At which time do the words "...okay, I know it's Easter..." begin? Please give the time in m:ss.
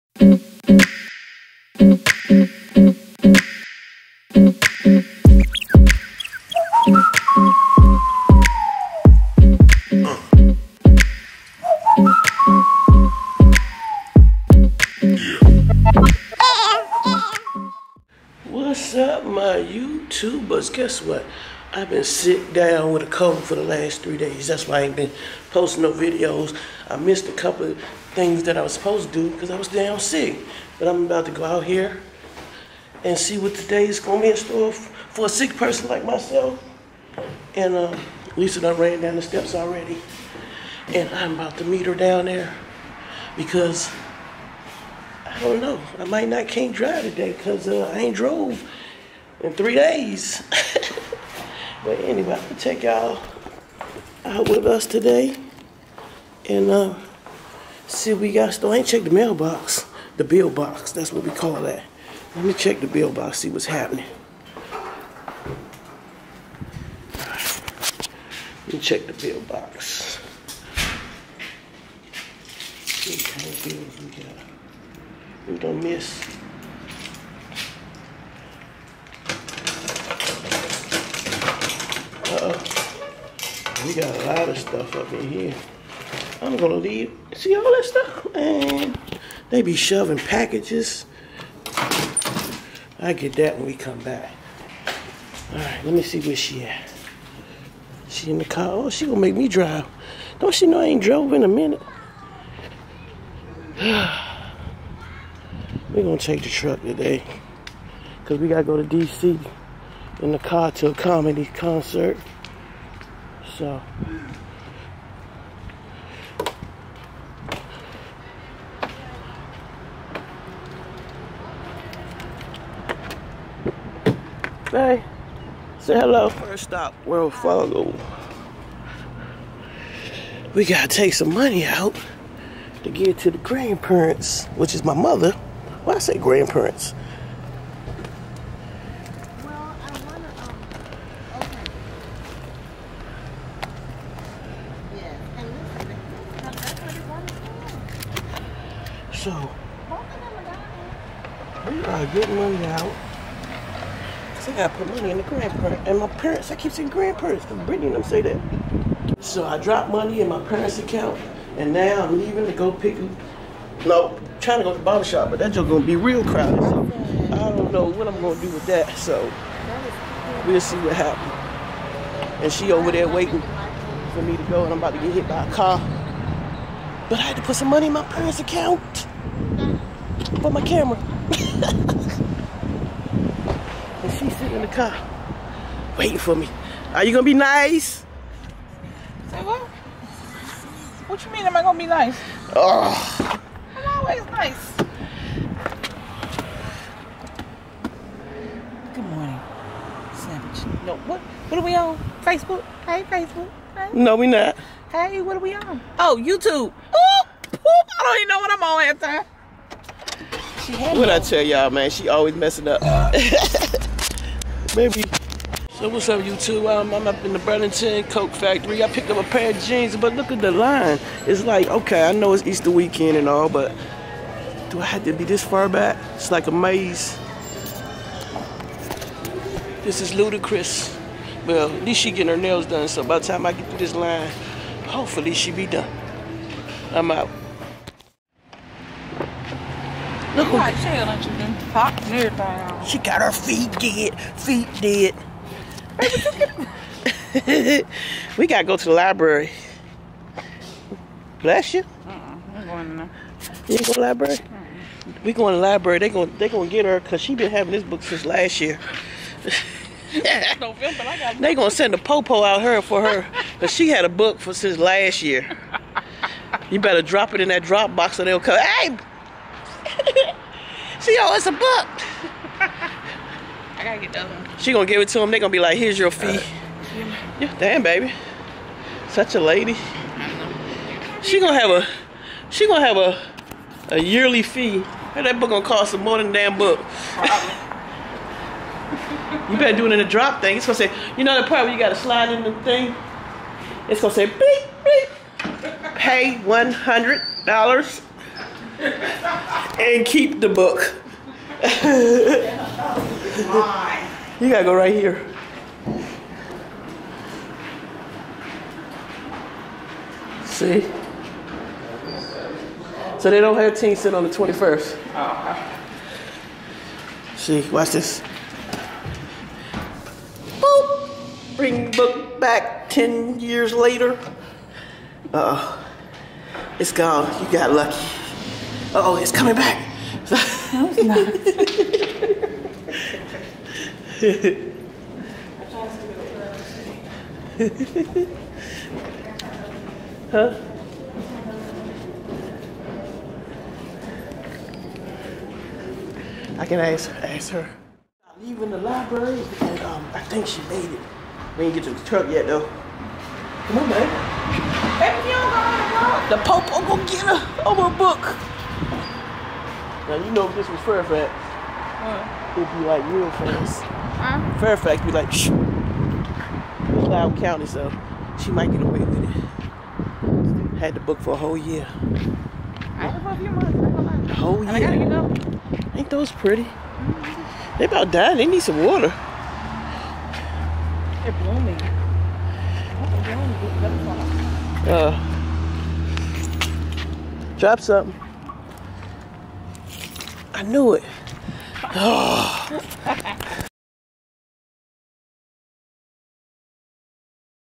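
3:41.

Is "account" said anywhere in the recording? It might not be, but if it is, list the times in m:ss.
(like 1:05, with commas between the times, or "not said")
2:40, 2:58.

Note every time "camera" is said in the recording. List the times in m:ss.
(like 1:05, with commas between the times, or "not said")
3:00.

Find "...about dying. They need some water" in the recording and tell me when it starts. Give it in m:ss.
6:17.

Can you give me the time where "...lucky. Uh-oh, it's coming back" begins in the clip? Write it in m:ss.
5:27.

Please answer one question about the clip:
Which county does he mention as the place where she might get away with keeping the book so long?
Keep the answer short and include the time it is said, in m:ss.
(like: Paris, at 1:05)
Loudoun County, at 6:06.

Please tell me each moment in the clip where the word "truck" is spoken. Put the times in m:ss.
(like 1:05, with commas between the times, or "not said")
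1:46, 5:52.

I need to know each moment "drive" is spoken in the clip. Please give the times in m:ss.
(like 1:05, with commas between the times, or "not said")
0:46, 1:39.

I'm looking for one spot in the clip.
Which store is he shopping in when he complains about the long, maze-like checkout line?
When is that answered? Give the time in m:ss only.
3:37.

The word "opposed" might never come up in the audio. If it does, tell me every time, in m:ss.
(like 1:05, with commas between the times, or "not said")
not said.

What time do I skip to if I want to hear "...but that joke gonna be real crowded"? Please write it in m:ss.
2:45.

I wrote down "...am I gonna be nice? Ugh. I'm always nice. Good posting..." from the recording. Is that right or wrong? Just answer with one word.
wrong.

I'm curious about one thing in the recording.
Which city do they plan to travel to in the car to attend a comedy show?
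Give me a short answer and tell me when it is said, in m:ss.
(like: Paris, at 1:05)
DC, at 1:48.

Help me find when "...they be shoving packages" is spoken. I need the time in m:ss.
1:29.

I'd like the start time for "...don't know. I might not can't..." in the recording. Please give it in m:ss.
0:45.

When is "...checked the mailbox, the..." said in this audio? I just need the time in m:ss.
0:58.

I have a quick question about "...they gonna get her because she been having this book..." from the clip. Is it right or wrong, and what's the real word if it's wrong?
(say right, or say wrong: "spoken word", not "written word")
right.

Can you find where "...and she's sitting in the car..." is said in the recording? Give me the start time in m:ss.
3:01.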